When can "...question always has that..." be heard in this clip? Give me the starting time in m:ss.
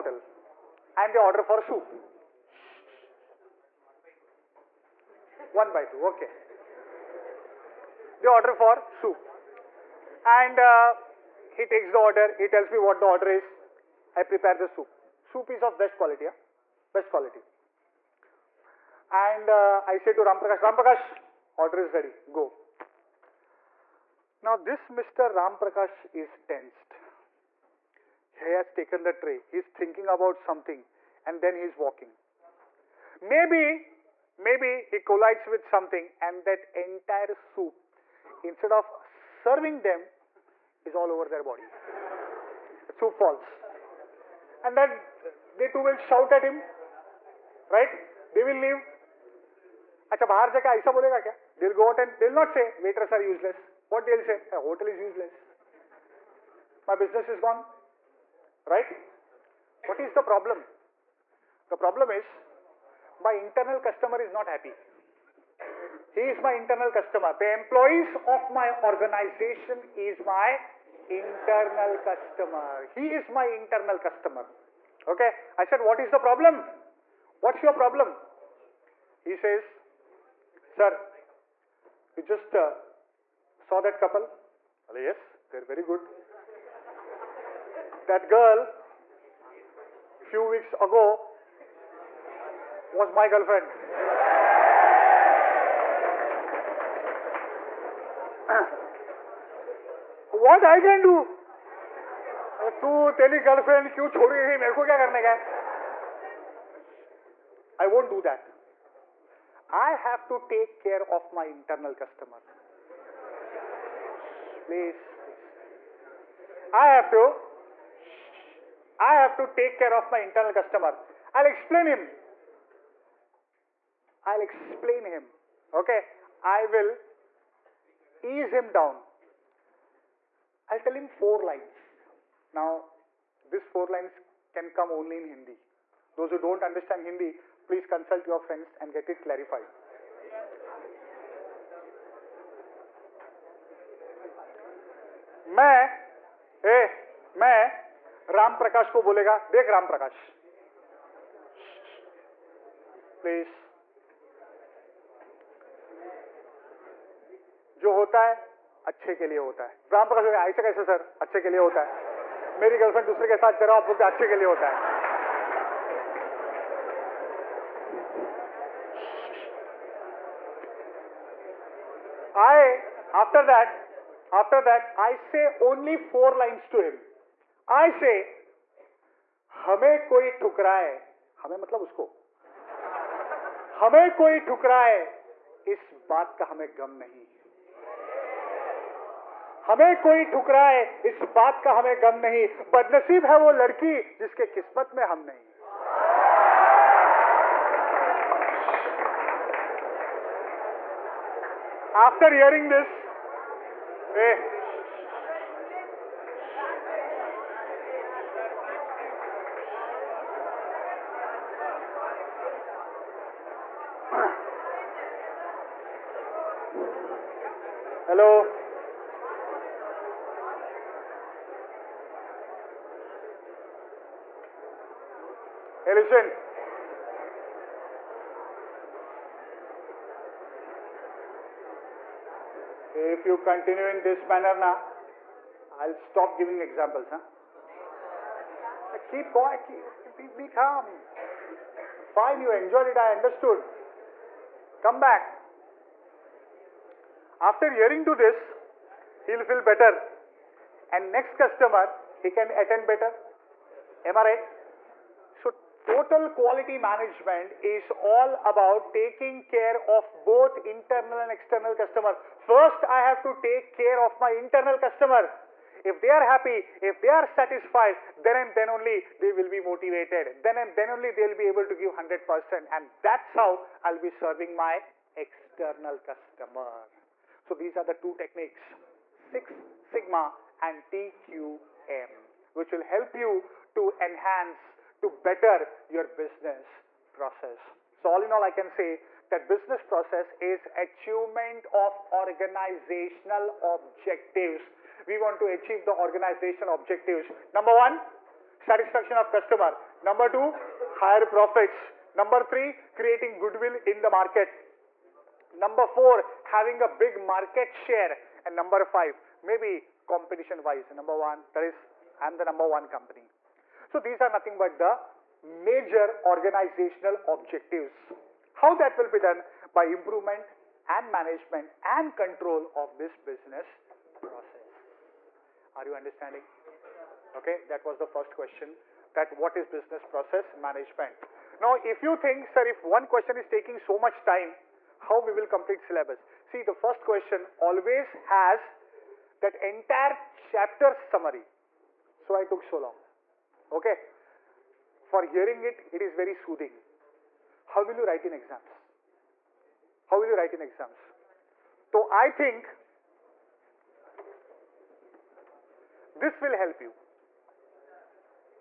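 5:37.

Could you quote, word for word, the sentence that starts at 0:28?
He has taken the tray, he's thinking about something and then he's walking.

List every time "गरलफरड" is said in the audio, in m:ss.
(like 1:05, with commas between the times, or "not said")
1:43, 2:42.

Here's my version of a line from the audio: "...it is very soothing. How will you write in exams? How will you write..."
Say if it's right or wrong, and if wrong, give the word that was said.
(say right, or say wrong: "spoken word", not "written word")
right.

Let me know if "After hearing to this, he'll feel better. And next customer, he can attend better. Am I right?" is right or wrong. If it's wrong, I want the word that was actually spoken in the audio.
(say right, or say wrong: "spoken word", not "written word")
right.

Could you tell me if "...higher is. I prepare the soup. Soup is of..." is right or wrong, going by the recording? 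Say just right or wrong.
wrong.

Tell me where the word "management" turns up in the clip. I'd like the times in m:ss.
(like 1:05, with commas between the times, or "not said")
4:16, 5:21, 5:30.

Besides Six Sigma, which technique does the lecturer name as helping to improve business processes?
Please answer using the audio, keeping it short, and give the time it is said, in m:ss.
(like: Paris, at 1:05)
TQM, at 4:40.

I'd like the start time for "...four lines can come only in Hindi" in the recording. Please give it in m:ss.
2:13.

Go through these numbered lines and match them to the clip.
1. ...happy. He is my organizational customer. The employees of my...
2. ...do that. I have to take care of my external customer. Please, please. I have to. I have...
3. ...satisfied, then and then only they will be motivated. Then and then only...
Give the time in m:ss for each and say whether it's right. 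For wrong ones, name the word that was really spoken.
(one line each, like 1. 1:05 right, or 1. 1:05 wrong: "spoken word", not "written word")
1. 1:04 wrong: "internal", not "organizational"
2. 1:48 wrong: "internal", not "external"
3. 4:27 right.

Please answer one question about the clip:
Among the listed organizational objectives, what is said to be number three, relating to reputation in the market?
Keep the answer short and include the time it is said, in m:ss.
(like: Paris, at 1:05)
Creating goodwill, at 5:02.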